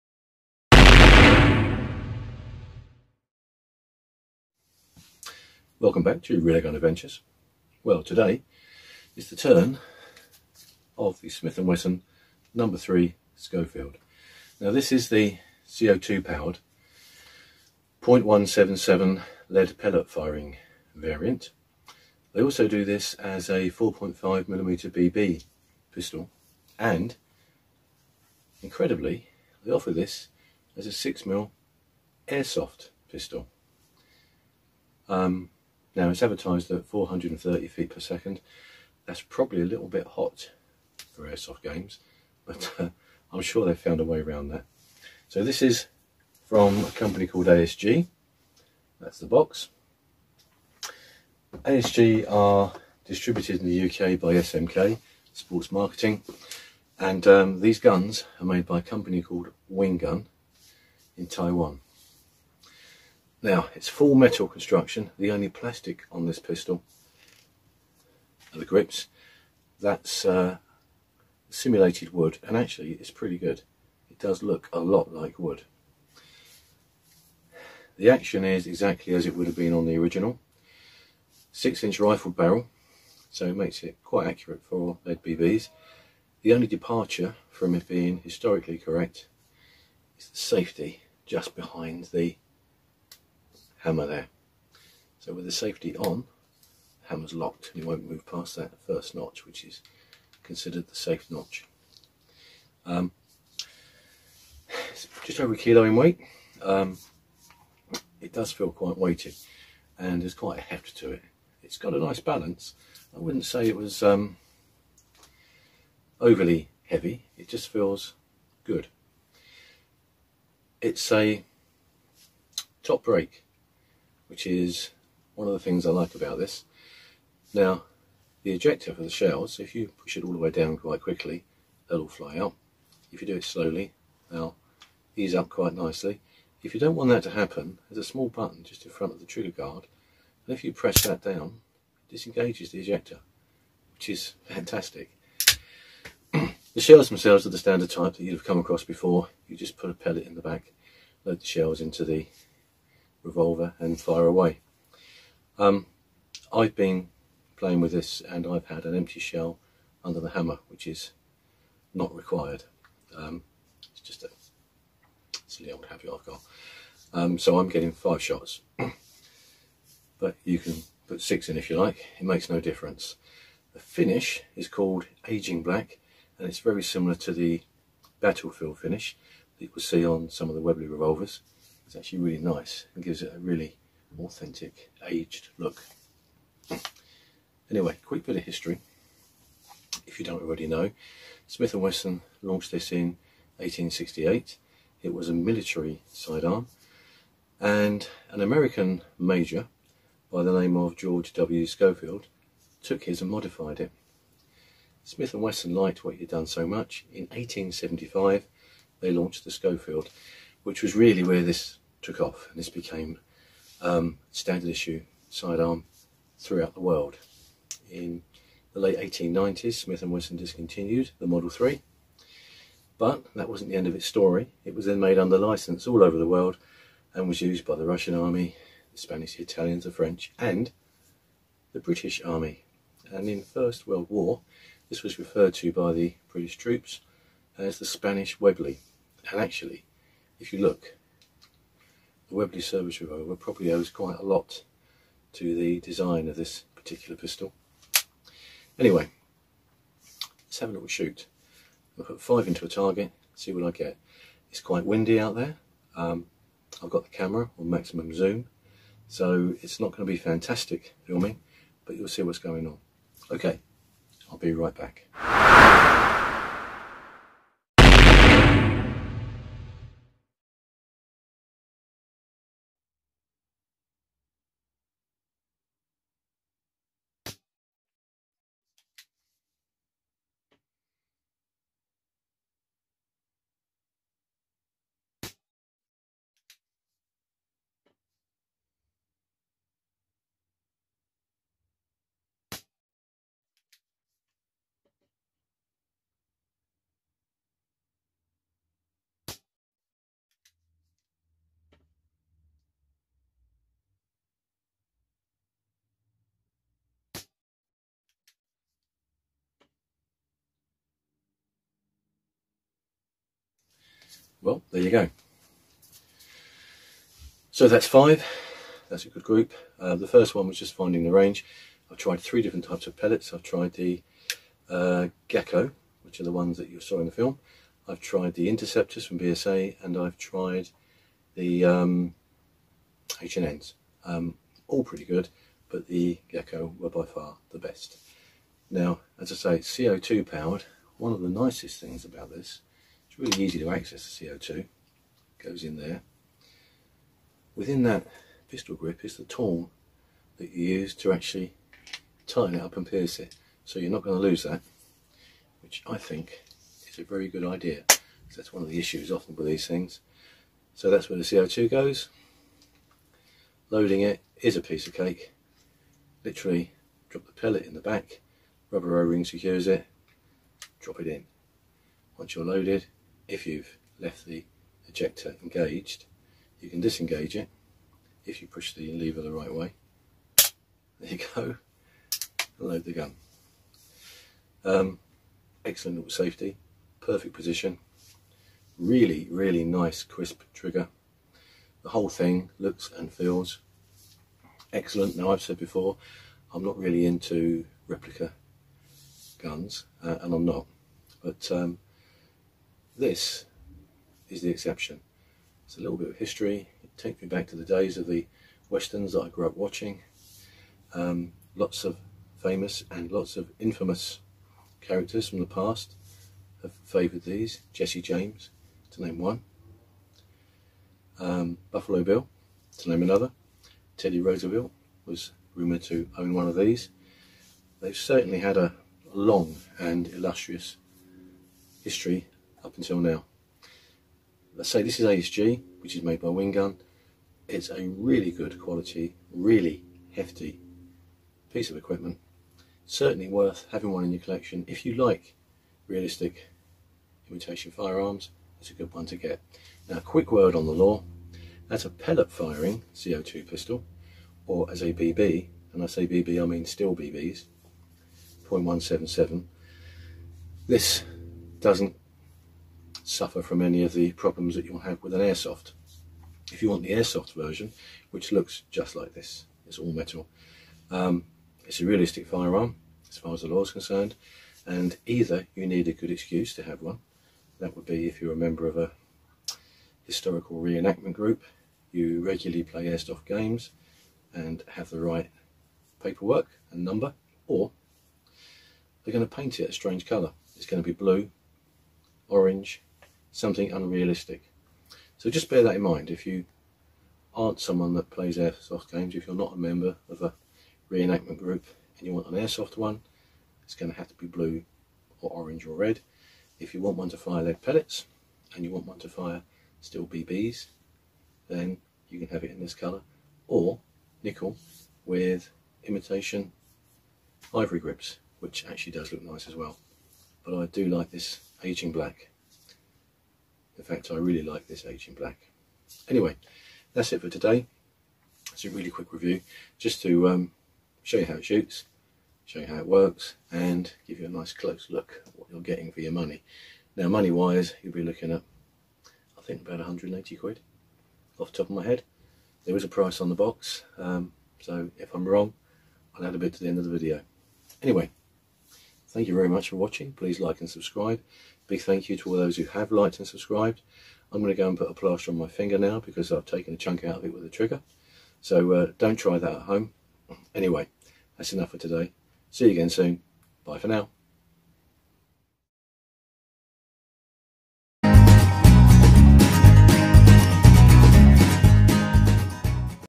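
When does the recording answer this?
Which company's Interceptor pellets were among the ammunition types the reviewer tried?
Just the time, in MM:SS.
05:29.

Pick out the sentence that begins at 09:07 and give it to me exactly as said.
Anyway, thank you very much for watching.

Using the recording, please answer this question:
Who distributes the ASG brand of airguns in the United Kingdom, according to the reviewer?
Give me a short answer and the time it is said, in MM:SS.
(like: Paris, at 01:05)
SMK, at 00:54.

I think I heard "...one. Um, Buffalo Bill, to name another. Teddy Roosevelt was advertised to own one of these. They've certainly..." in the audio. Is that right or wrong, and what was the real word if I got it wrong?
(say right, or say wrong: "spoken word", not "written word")
wrong: "rumoured", not "advertised".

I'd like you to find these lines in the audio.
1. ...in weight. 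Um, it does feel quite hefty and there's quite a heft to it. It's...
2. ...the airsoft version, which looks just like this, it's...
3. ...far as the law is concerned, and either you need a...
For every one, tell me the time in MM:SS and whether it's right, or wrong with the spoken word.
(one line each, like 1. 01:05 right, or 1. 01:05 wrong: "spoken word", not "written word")
1. 01:45 wrong: "weighty", not "hefty"
2. 07:46 right
3. 07:53 right.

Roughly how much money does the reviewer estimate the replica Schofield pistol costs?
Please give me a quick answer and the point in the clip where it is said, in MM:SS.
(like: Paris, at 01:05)
£180, at 08:59.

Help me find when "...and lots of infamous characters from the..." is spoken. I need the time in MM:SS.
06:52.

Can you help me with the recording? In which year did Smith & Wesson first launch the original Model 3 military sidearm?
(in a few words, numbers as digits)
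1868.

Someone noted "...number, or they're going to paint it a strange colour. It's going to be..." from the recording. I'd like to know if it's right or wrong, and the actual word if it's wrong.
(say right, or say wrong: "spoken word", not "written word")
right.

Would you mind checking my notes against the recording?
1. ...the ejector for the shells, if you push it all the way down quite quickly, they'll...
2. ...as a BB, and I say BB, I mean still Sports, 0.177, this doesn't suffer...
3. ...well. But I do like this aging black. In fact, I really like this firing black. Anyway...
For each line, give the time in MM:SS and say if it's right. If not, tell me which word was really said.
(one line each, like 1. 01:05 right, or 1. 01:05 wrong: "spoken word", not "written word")
1. 02:08 right
2. 07:34 wrong: "BBs", not "Sports"
3. 08:39 wrong: "aging", not "firing".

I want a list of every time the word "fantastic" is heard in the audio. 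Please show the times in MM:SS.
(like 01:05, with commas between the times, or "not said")
02:24, 04:20.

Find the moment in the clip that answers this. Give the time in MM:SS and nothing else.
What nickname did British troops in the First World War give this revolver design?
03:57.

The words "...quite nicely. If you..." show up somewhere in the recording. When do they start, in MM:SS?
02:15.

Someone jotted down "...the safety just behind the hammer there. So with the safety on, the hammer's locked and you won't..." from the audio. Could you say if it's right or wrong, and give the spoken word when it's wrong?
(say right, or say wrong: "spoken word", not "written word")
right.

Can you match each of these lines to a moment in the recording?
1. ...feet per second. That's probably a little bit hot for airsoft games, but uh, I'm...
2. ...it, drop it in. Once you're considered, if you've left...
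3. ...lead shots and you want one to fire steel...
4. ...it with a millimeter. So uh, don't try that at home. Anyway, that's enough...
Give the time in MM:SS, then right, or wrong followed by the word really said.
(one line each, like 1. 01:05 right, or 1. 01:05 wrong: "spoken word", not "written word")
1. 00:37 right
2. 06:09 wrong: "loaded", not "considered"
3. 08:27 wrong: "pellets", not "shots"
4. 09:17 wrong: "trigger", not "millimeter".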